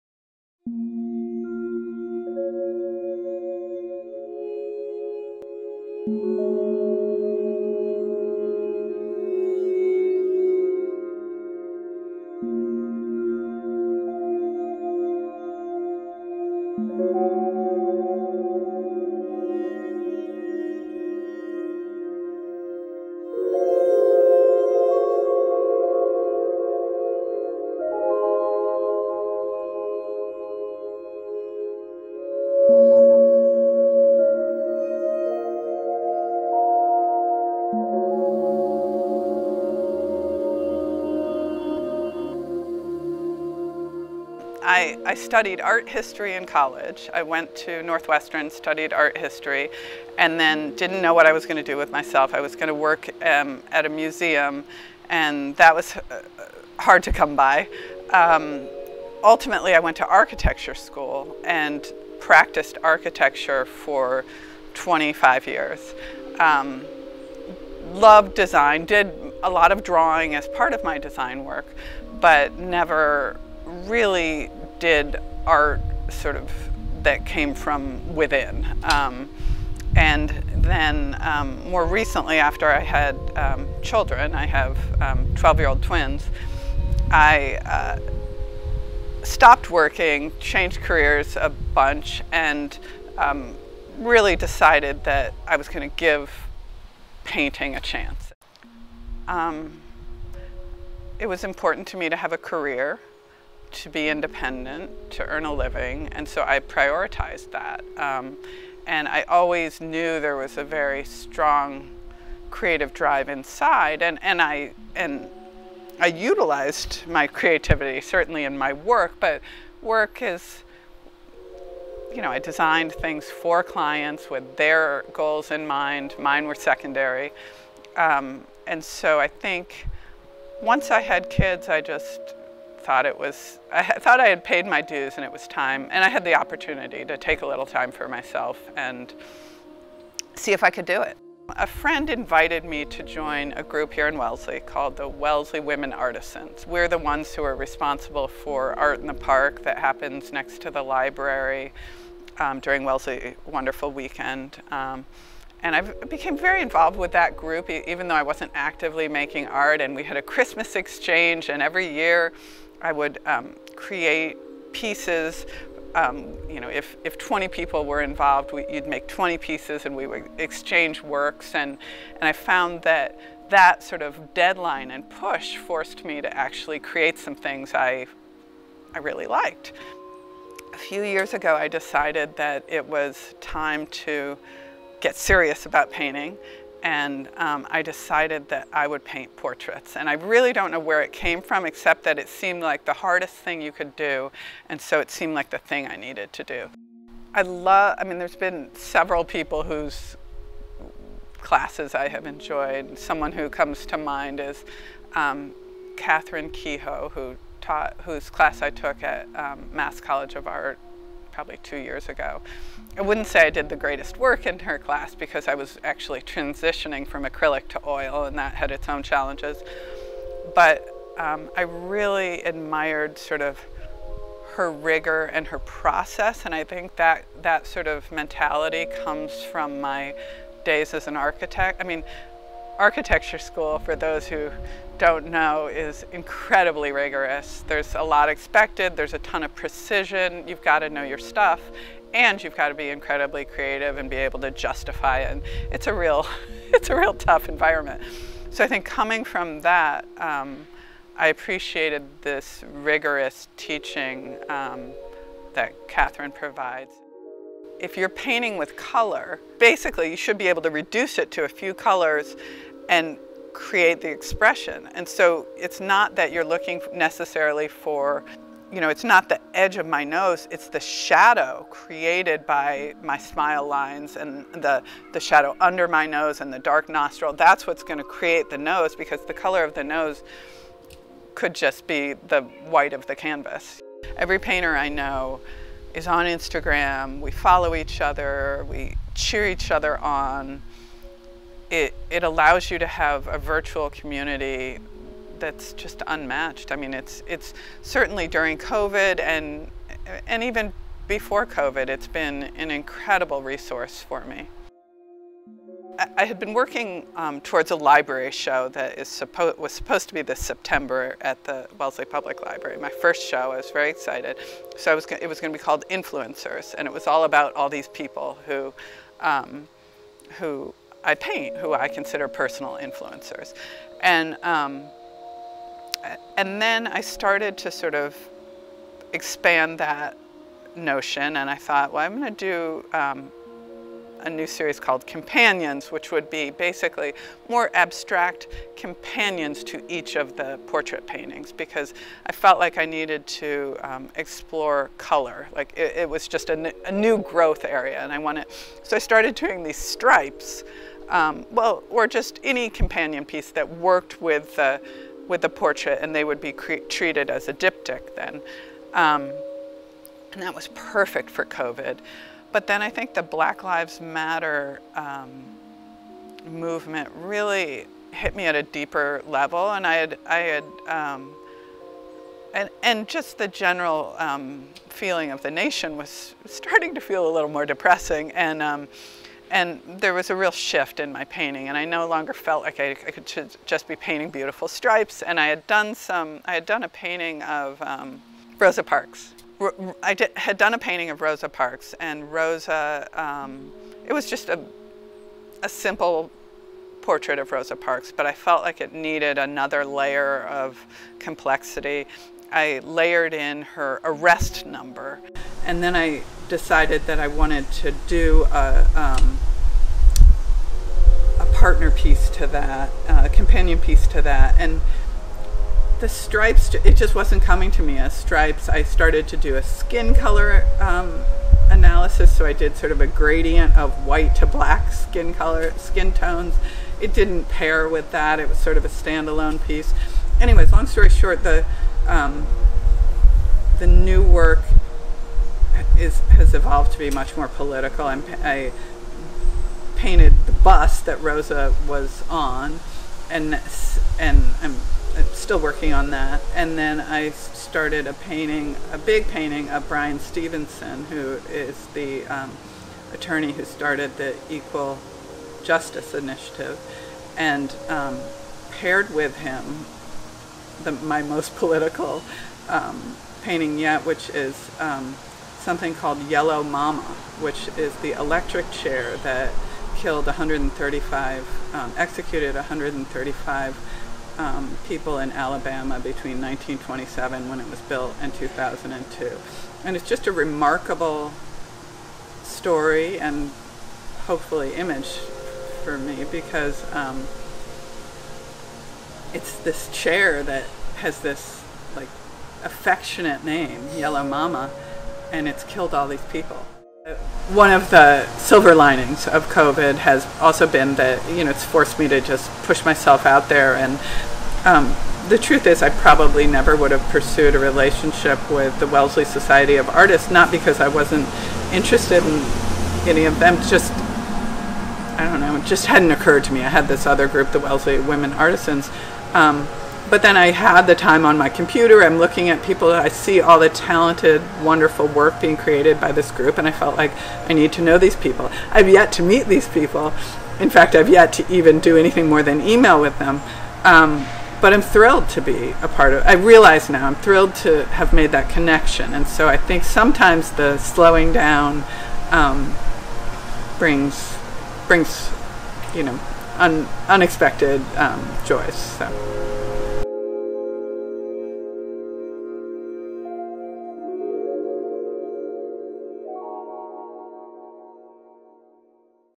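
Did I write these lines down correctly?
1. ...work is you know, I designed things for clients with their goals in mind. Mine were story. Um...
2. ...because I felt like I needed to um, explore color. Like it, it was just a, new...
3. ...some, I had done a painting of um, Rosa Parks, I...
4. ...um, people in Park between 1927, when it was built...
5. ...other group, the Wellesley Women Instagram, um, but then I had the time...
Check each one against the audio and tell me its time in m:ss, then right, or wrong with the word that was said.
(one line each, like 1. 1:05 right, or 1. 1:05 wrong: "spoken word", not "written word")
1. 1:59 wrong: "secondary", not "story"
2. 5:41 right
3. 6:25 right
4. 7:54 wrong: "Alabama", not "Park"
5. 8:37 wrong: "Artisans", not "Instagram".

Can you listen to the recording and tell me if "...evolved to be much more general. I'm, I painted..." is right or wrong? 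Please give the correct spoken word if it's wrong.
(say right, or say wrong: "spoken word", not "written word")
wrong: "political", not "general".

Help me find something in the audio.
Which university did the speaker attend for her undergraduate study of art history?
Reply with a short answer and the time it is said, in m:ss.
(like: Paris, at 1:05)
Northwestern, at 0:47.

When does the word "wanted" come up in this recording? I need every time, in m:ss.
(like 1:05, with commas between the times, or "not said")
5:48, 6:47.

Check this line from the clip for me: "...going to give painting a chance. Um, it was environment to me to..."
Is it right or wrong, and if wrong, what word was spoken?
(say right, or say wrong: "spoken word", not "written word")
wrong: "important", not "environment".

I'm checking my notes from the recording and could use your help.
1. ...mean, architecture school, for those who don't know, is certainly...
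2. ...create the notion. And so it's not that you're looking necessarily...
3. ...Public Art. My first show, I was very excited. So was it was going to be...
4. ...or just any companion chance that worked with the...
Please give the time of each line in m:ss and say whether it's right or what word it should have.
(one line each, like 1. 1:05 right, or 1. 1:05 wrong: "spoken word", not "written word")
1. 3:51 wrong: "incredibly", not "certainly"
2. 4:23 wrong: "expression", not "notion"
3. 5:12 wrong: "Library", not "Art"
4. 5:51 wrong: "piece", not "chance".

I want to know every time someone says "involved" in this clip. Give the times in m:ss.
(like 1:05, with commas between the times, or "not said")
2:36, 2:48.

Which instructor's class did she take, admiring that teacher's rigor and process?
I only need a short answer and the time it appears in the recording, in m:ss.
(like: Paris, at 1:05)
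Catherine Kehoe, at 3:25.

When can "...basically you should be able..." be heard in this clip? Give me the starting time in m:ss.
4:19.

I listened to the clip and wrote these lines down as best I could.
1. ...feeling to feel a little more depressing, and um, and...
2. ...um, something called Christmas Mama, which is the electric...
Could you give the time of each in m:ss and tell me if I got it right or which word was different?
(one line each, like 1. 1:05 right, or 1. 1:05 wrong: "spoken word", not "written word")
1. 6:16 wrong: "starting", not "feeling"
2. 7:44 wrong: "Yellow", not "Christmas".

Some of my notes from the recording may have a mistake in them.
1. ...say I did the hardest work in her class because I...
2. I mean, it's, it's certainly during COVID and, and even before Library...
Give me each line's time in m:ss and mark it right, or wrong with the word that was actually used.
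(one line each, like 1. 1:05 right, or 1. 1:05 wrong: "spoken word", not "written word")
1. 3:33 wrong: "greatest", not "hardest"
2. 4:56 wrong: "COVID", not "Library".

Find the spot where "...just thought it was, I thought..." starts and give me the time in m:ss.
2:11.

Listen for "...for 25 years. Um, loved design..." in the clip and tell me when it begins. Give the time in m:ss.
1:03.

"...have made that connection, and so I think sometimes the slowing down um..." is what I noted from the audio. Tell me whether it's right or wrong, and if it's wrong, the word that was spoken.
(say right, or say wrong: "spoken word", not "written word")
right.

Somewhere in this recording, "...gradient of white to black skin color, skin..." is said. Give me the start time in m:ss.
7:03.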